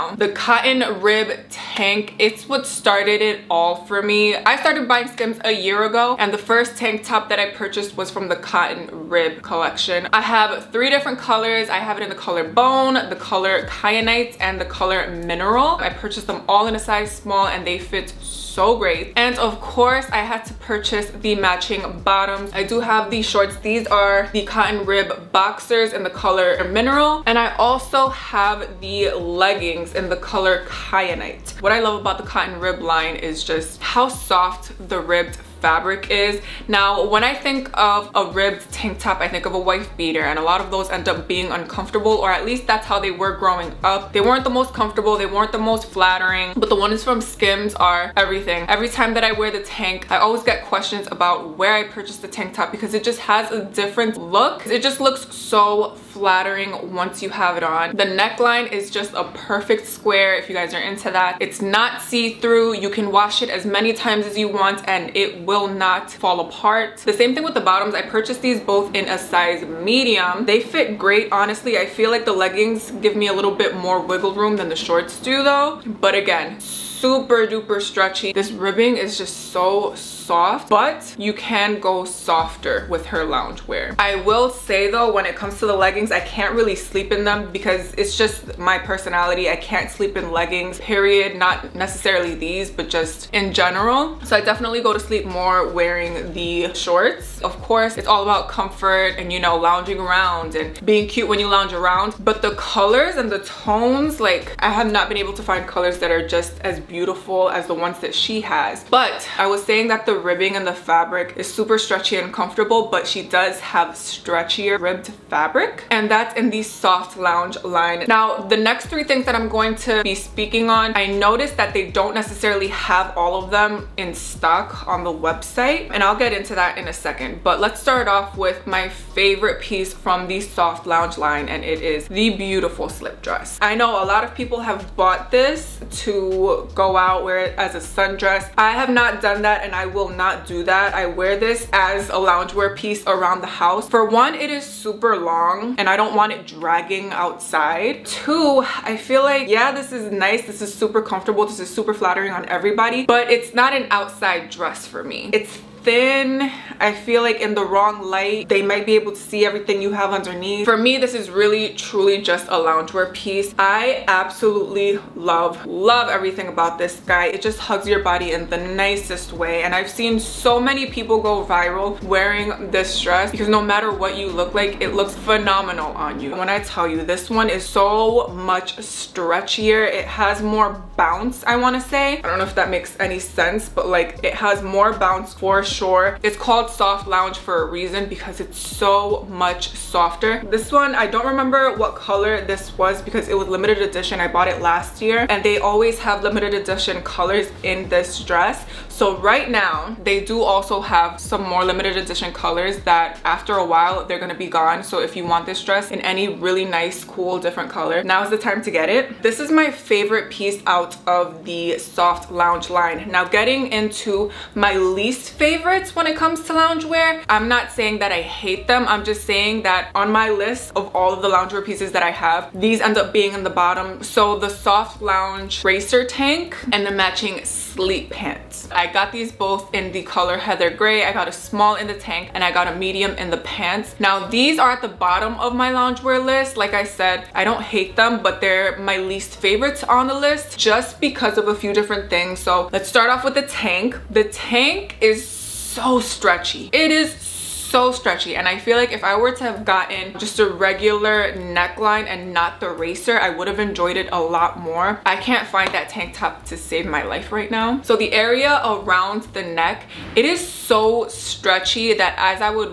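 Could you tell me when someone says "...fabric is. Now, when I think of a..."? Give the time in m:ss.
0:35.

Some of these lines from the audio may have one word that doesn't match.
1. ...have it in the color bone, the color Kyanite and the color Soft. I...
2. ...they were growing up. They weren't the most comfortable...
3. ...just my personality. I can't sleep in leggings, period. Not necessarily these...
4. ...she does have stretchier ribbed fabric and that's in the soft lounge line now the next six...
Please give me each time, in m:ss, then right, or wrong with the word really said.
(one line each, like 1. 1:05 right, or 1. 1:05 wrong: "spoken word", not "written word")
1. 0:11 wrong: "Mineral", not "Soft"
2. 0:42 right
3. 1:28 right
4. 1:53 wrong: "three", not "six".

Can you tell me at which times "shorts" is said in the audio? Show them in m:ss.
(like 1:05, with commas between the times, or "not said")
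0:23, 1:14, 1:36.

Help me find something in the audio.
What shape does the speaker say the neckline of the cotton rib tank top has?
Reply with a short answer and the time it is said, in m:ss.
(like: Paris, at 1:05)
Square, at 0:59.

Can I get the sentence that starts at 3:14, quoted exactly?
I bought it last year and they always have limited edition colors in this dress.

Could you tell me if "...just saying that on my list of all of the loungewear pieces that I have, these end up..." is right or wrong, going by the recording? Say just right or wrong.
right.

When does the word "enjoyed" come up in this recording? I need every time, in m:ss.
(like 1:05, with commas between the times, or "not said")
4:13.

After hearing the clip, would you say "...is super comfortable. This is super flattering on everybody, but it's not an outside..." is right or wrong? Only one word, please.
right.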